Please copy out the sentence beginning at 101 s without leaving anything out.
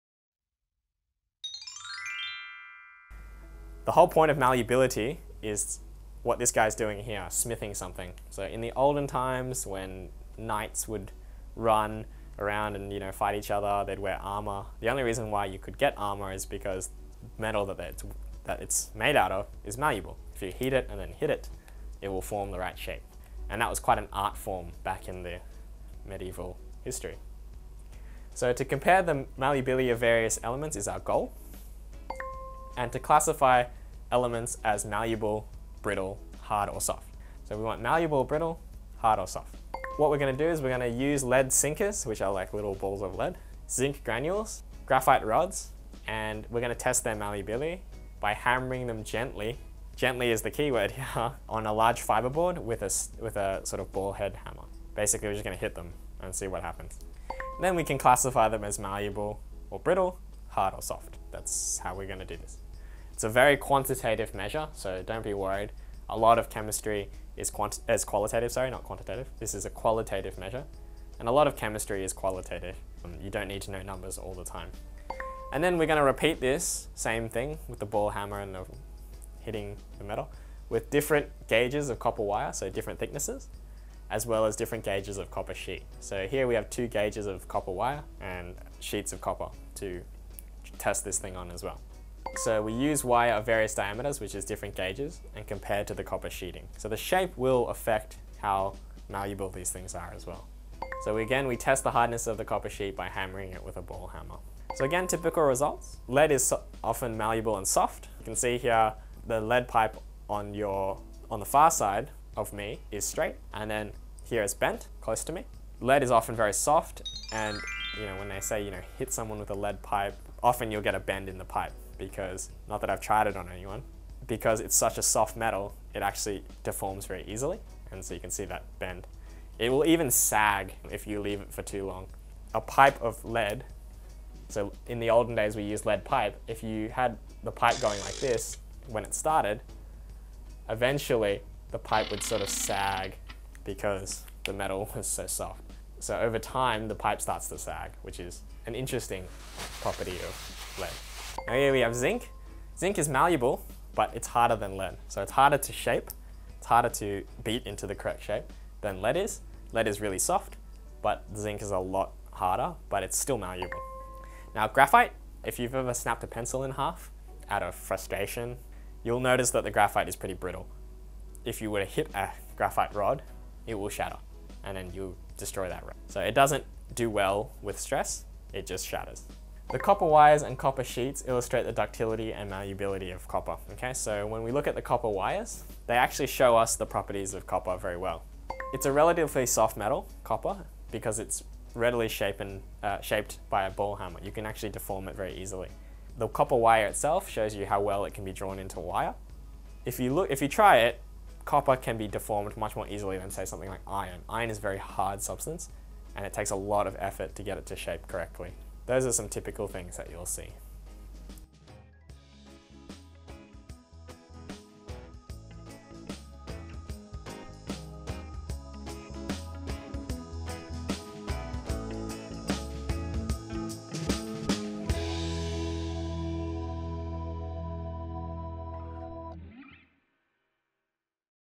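So again, we test the hardness of the copper sheet by hammering it with a ball hammer.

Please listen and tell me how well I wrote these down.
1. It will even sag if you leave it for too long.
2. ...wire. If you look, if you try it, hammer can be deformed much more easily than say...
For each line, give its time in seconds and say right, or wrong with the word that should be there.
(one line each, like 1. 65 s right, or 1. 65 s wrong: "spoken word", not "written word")
1. 129 s right
2. 198 s wrong: "copper", not "hammer".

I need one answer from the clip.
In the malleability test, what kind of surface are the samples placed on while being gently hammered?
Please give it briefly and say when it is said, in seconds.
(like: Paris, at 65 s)
Large fiber board, at 51 s.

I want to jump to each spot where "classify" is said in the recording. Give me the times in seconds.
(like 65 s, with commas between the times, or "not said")
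32 s, 57 s.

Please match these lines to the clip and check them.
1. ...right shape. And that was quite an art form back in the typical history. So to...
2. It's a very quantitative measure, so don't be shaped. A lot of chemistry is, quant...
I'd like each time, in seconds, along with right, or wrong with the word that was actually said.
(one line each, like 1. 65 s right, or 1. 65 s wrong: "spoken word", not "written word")
1. 22 s wrong: "medieval", not "typical"
2. 63 s wrong: "worried", not "shaped".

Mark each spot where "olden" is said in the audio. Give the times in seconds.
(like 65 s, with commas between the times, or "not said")
8 s, 135 s.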